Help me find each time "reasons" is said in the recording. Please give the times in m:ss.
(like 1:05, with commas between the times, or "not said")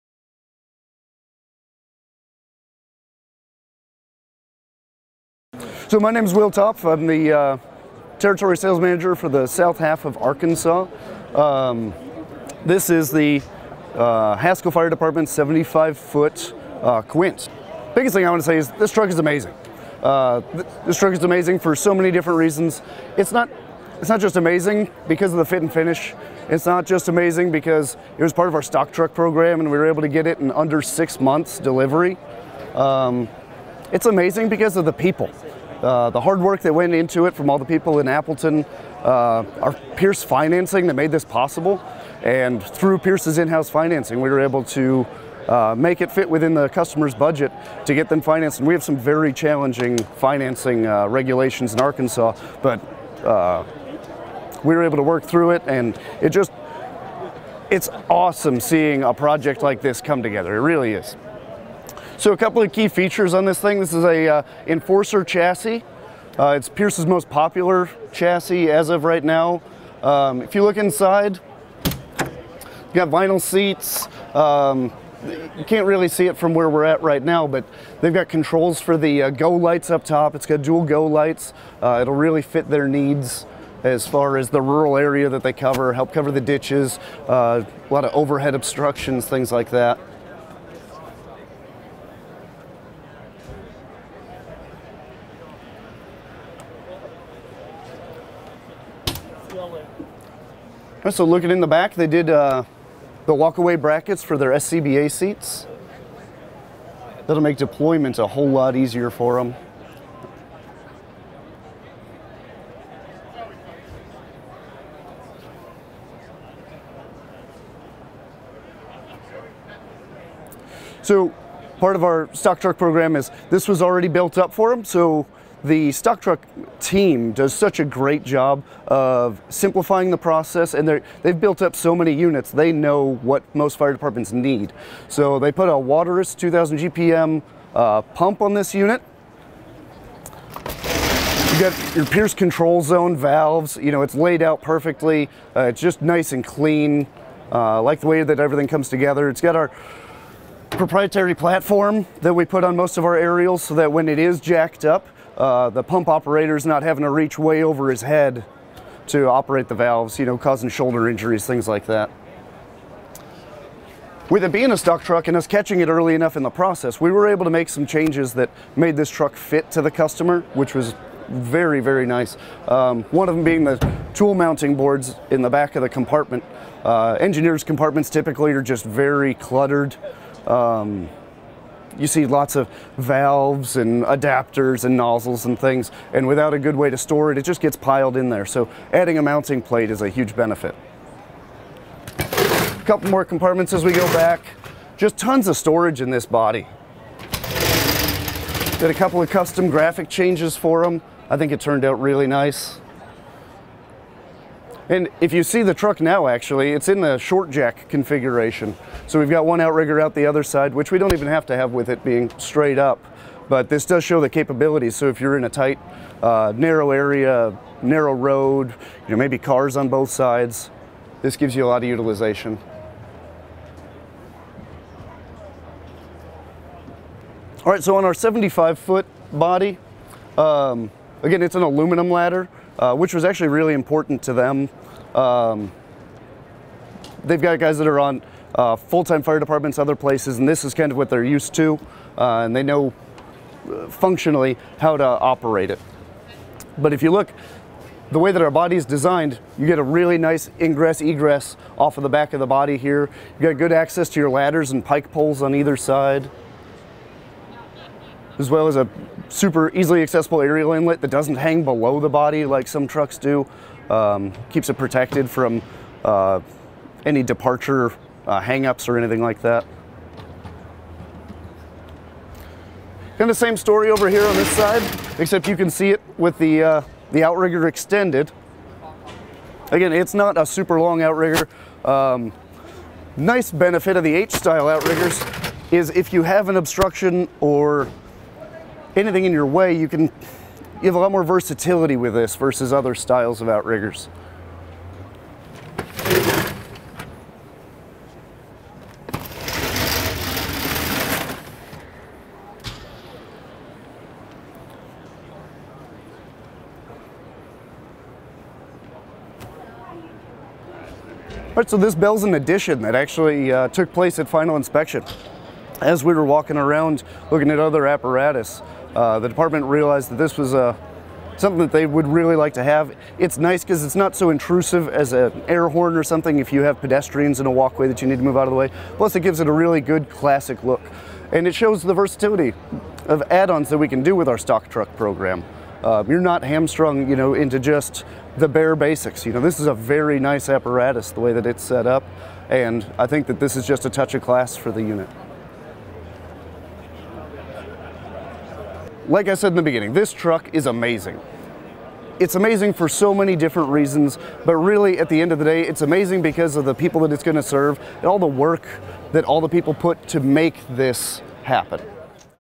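0:22, 5:53.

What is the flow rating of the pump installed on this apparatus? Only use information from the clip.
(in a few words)
2000 gpm.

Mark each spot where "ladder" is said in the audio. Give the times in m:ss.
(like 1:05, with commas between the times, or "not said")
3:52, 4:14.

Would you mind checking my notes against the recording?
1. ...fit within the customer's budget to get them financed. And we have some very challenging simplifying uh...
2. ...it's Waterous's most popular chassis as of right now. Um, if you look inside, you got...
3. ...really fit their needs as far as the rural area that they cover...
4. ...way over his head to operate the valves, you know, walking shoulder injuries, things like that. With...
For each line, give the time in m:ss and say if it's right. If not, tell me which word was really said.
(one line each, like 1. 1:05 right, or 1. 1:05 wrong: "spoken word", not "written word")
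1. 0:46 wrong: "financing", not "simplifying"
2. 1:06 wrong: "Pierce", not "Waterous"
3. 1:22 right
4. 2:37 wrong: "causing", not "walking".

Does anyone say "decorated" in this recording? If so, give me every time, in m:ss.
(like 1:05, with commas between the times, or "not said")
not said.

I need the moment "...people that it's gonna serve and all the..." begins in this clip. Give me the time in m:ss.
5:56.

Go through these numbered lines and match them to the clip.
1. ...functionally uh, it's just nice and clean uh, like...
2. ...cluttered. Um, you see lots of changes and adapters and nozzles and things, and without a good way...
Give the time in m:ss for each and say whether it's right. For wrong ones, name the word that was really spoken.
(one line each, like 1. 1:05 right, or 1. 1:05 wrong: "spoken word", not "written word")
1. 2:24 wrong: "perfectly", not "functionally"
2. 2:59 wrong: "valves", not "changes".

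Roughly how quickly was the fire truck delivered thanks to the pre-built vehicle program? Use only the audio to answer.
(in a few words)
Under six months.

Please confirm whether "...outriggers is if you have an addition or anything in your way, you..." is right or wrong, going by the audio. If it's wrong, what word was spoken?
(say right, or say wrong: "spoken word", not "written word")
wrong: "obstruction", not "addition".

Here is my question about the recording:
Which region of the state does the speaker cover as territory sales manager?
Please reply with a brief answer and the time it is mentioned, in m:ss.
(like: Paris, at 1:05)
South half of Arkansas, at 0:09.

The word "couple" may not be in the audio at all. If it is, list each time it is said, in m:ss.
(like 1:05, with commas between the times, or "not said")
1:02, 3:12, 3:18.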